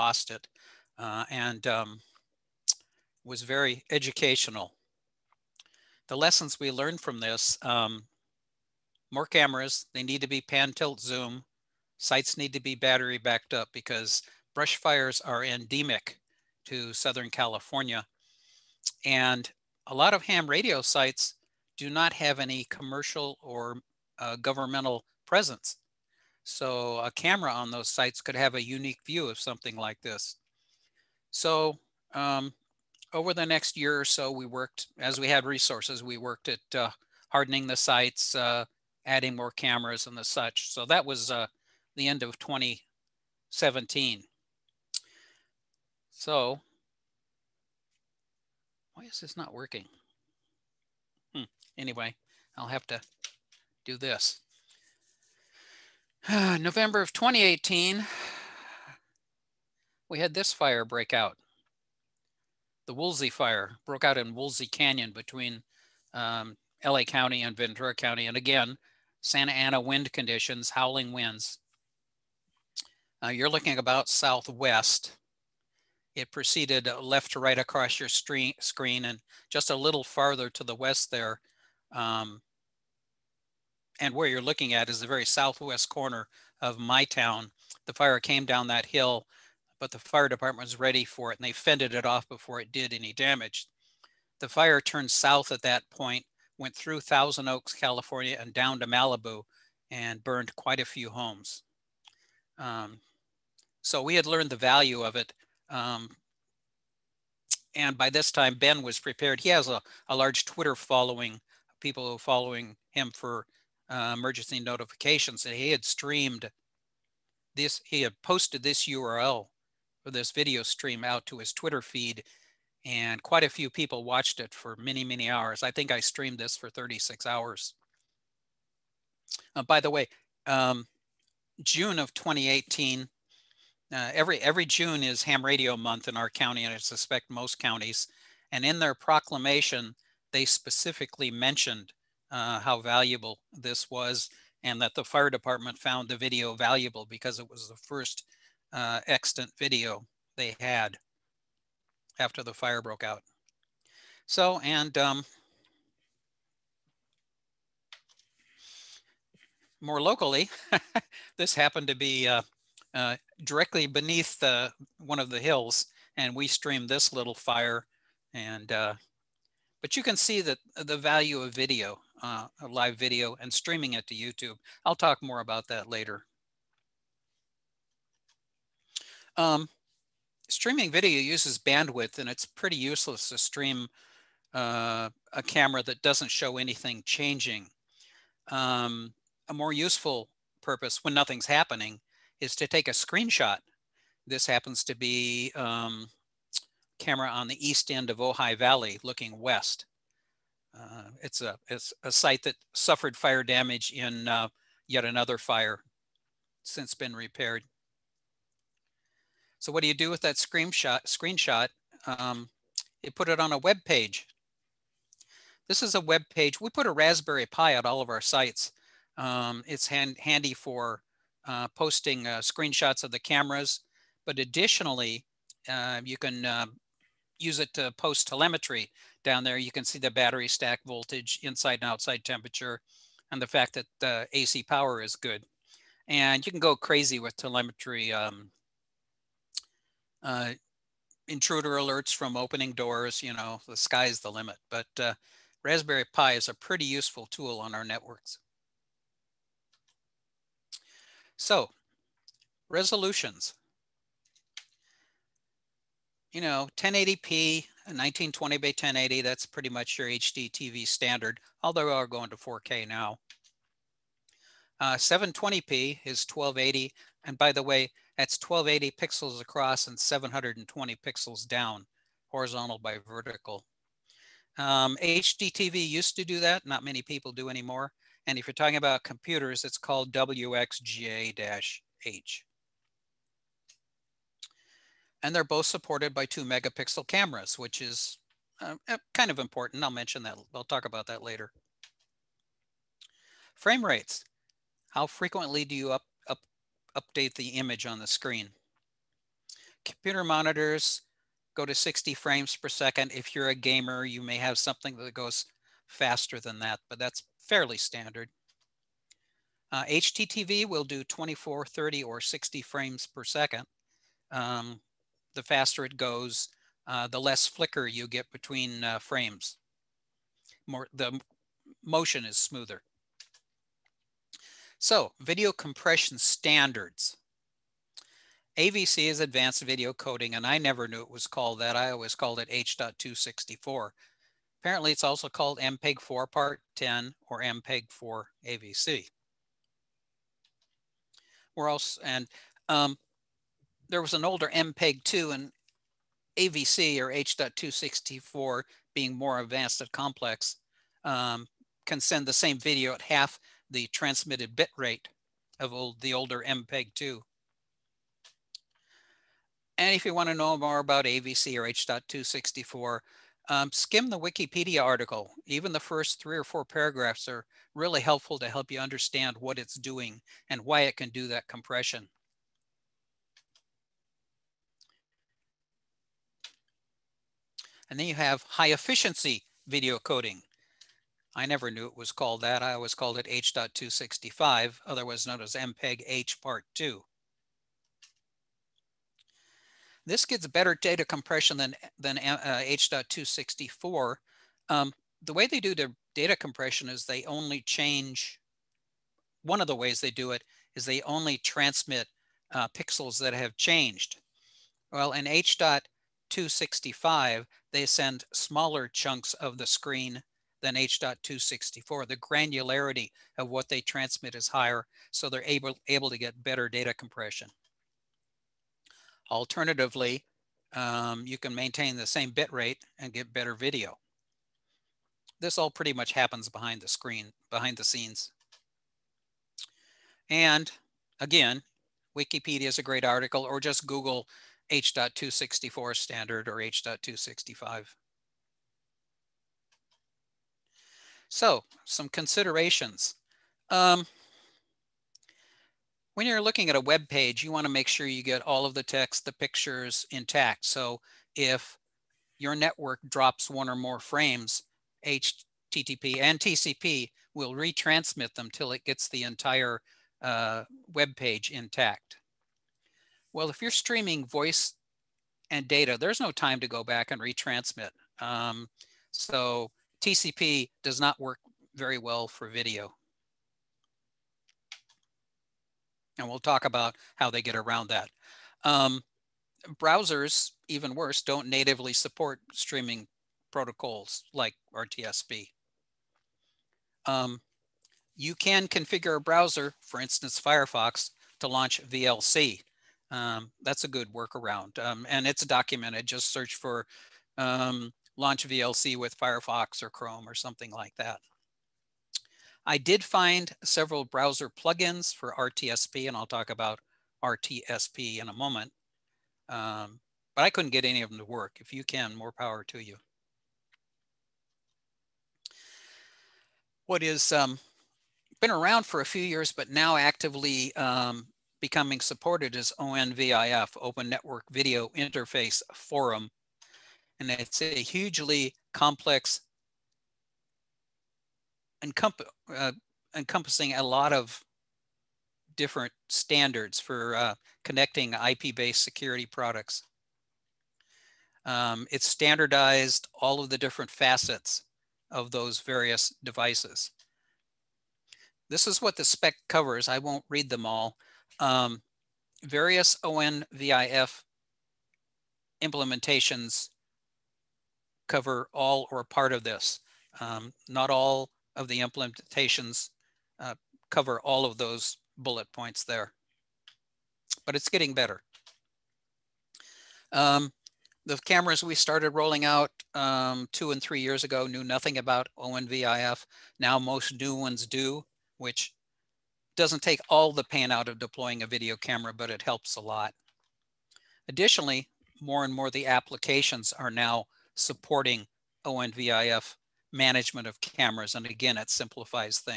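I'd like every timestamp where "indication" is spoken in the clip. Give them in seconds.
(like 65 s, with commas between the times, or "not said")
not said.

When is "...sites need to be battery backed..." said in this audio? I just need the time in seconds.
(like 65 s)
11 s.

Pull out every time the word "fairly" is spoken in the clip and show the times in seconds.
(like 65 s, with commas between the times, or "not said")
307 s.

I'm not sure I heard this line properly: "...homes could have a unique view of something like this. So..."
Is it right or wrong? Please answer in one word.
wrong.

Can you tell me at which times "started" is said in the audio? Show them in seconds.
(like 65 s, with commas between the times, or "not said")
571 s.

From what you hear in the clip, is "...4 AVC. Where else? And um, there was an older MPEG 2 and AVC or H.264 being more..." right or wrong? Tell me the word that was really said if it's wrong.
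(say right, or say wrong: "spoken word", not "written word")
right.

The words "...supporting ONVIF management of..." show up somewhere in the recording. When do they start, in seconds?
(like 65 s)
587 s.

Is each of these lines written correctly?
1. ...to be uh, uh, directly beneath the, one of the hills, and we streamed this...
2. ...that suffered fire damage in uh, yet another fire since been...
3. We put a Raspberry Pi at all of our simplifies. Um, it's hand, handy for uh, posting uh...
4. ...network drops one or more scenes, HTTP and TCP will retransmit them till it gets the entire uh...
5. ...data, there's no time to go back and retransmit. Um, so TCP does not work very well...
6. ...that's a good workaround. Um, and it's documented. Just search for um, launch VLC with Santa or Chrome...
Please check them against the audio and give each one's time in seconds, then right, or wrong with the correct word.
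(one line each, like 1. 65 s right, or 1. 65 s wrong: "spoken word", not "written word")
1. 161 s right
2. 202 s right
3. 216 s wrong: "sites", not "simplifies"
4. 452 s wrong: "frames", not "scenes"
5. 465 s right
6. 493 s wrong: "Firefox", not "Santa".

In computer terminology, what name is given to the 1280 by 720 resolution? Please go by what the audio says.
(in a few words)
WXGA-H.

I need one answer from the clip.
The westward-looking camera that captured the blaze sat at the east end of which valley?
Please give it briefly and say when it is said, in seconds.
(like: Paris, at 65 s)
Ojai Valley, at 198 s.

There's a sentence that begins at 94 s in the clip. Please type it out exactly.
The fire turned south at that point, went through Thousand Oaks, California, and down to Malibu and burned quite a few homes.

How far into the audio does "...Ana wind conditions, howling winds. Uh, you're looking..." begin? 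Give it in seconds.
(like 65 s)
69 s.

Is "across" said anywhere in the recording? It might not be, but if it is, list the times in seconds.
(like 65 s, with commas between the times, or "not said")
77 s, 269 s.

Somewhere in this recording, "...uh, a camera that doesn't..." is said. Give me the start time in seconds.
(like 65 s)
184 s.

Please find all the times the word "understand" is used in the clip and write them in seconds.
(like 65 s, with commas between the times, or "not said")
368 s.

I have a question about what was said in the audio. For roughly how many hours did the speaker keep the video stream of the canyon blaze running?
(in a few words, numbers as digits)
36 hours.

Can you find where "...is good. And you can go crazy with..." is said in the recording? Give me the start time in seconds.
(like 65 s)
235 s.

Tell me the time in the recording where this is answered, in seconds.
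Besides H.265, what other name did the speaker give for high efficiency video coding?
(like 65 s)
385 s.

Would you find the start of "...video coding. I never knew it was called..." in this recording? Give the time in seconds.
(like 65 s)
379 s.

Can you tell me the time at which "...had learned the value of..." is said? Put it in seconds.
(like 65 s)
104 s.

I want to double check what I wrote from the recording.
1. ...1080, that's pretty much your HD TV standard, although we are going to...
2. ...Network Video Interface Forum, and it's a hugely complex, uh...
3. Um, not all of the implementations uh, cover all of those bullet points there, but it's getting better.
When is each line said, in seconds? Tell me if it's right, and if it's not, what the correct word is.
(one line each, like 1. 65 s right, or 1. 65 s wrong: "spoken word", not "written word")
1. 258 s right
2. 524 s right
3. 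560 s right.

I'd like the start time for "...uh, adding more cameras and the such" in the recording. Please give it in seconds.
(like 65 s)
38 s.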